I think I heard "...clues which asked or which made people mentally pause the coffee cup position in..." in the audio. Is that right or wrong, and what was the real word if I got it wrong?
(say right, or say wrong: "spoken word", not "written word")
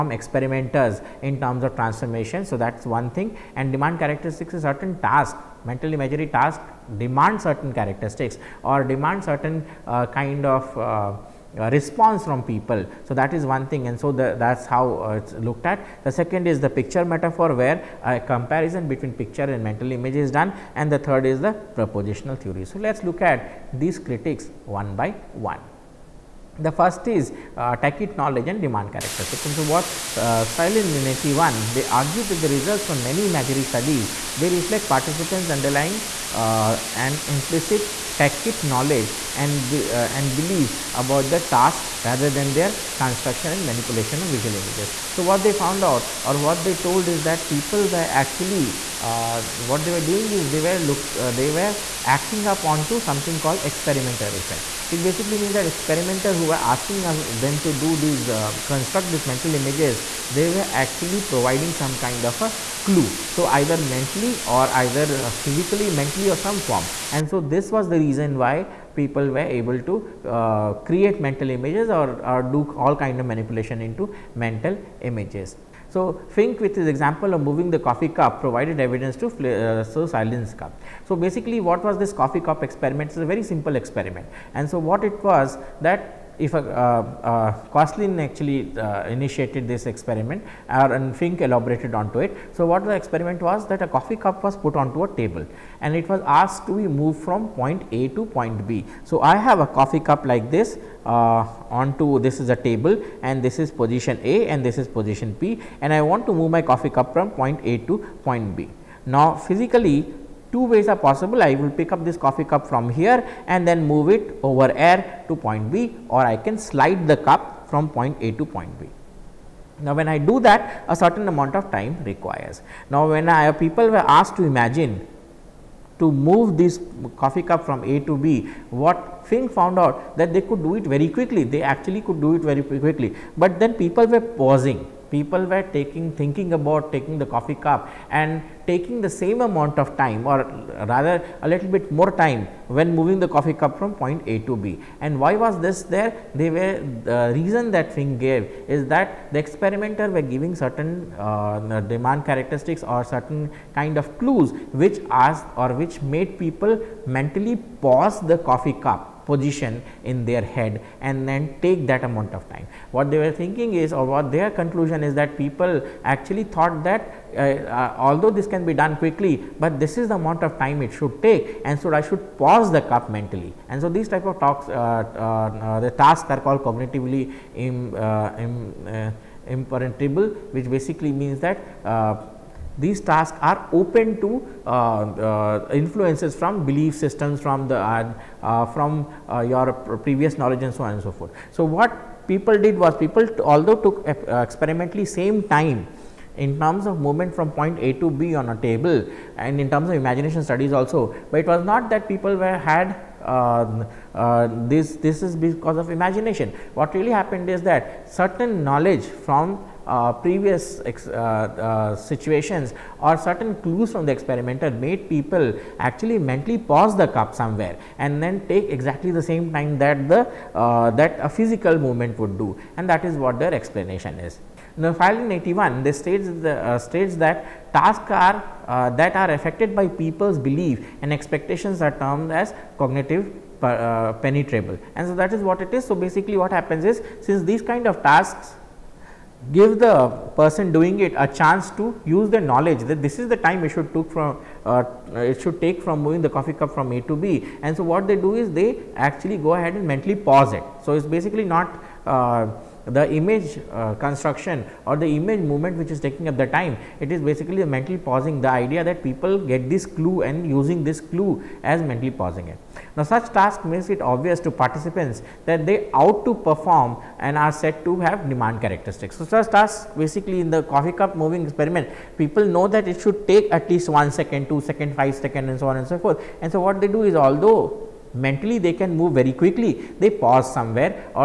right.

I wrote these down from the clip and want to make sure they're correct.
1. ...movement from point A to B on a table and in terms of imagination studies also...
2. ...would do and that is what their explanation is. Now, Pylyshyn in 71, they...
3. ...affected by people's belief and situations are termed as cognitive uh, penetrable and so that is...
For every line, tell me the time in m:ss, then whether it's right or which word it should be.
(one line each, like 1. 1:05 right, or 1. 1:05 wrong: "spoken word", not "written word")
1. 3:16 right
2. 3:42 wrong: "81", not "71"
3. 3:49 wrong: "expectations", not "situations".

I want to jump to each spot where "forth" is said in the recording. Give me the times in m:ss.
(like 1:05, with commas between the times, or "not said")
3:11, 4:35.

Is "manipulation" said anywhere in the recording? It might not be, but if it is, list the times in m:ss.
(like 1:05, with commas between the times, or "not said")
0:43, 1:13.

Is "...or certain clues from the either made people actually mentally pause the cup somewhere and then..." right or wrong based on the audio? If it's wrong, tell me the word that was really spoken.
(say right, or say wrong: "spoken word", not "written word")
wrong: "experimenter", not "either".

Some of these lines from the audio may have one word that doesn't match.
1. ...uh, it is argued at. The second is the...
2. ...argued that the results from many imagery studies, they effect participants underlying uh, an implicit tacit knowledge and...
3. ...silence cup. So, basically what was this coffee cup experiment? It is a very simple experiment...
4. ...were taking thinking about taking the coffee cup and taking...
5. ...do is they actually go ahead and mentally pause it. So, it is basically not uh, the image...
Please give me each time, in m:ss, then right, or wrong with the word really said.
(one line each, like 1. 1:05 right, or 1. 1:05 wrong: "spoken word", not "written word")
1. 0:15 wrong: "looked", not "argued"
2. 0:31 wrong: "reflect", not "effect"
3. 1:20 right
4. 2:15 right
5. 4:08 right.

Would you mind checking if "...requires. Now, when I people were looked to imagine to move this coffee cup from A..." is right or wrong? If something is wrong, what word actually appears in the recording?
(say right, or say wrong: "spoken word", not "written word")
wrong: "asked", not "looked".